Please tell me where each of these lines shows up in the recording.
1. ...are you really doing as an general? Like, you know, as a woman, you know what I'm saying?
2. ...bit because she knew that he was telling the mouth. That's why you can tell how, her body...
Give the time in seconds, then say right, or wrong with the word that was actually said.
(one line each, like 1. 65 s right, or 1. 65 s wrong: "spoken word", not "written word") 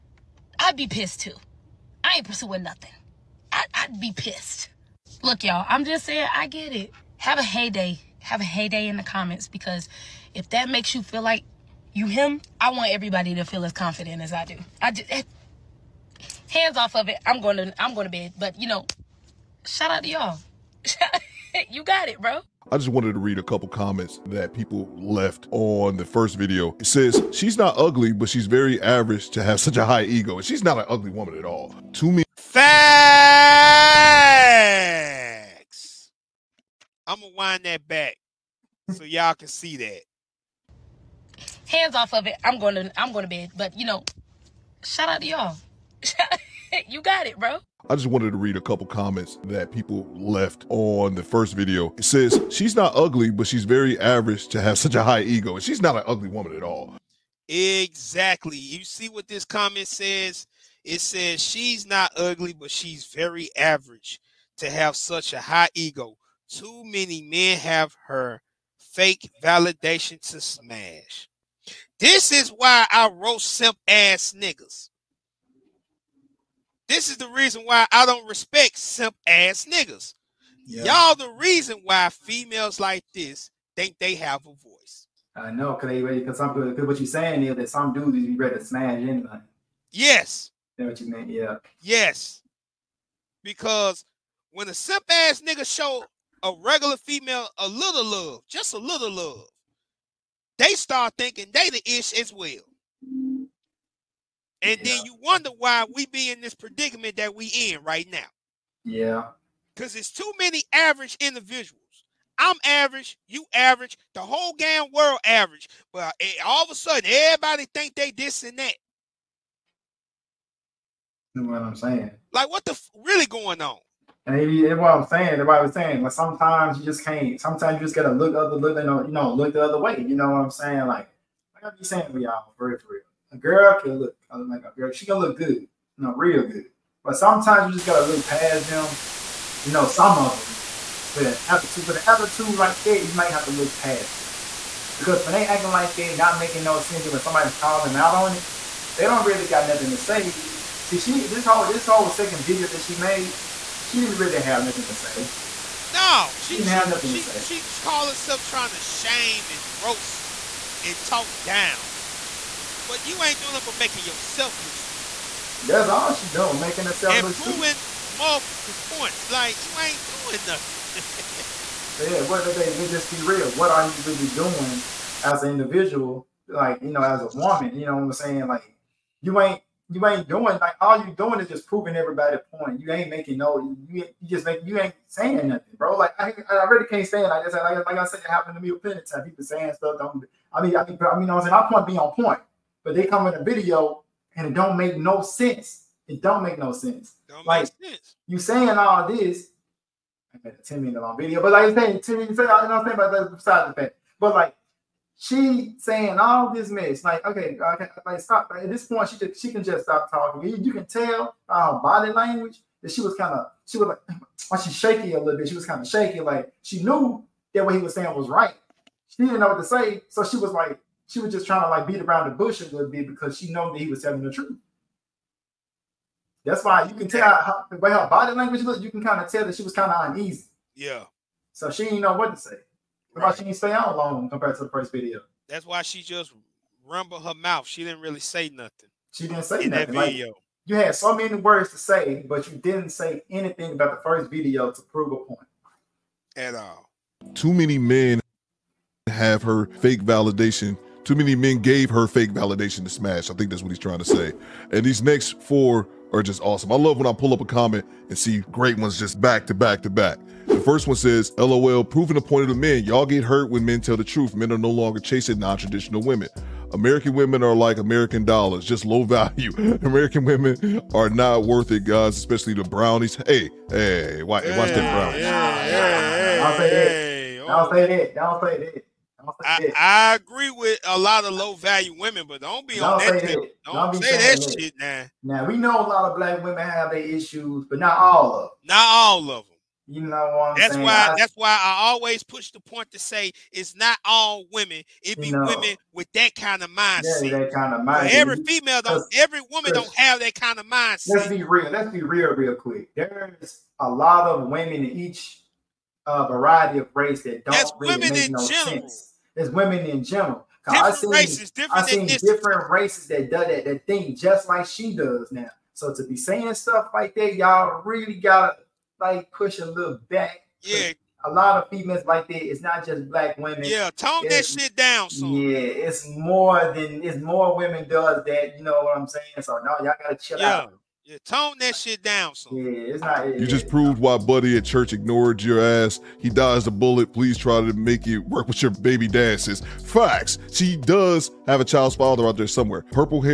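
1. 173 s wrong: "individual", not "general"
2. 222 s wrong: "truth", not "mouth".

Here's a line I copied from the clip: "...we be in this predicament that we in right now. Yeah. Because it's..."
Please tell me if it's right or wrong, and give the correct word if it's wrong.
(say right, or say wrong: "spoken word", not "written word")
right.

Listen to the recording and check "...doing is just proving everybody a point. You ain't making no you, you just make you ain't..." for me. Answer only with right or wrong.
right.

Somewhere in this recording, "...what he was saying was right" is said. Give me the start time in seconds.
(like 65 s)
217 s.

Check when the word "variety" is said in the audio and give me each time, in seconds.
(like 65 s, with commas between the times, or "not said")
306 s.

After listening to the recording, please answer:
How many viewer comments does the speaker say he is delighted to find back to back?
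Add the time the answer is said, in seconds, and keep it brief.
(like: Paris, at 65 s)
4, at 255 s.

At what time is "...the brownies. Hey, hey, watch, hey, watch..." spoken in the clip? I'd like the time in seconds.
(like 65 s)
272 s.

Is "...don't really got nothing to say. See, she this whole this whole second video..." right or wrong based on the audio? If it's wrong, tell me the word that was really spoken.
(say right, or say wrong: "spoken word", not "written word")
right.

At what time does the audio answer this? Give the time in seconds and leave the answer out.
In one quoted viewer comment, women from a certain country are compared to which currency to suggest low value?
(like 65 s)
267 s.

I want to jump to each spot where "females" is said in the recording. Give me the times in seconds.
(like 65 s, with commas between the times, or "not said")
82 s, 96 s, 298 s, 321 s.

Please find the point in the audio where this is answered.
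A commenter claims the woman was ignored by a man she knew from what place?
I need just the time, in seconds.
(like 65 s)
334 s.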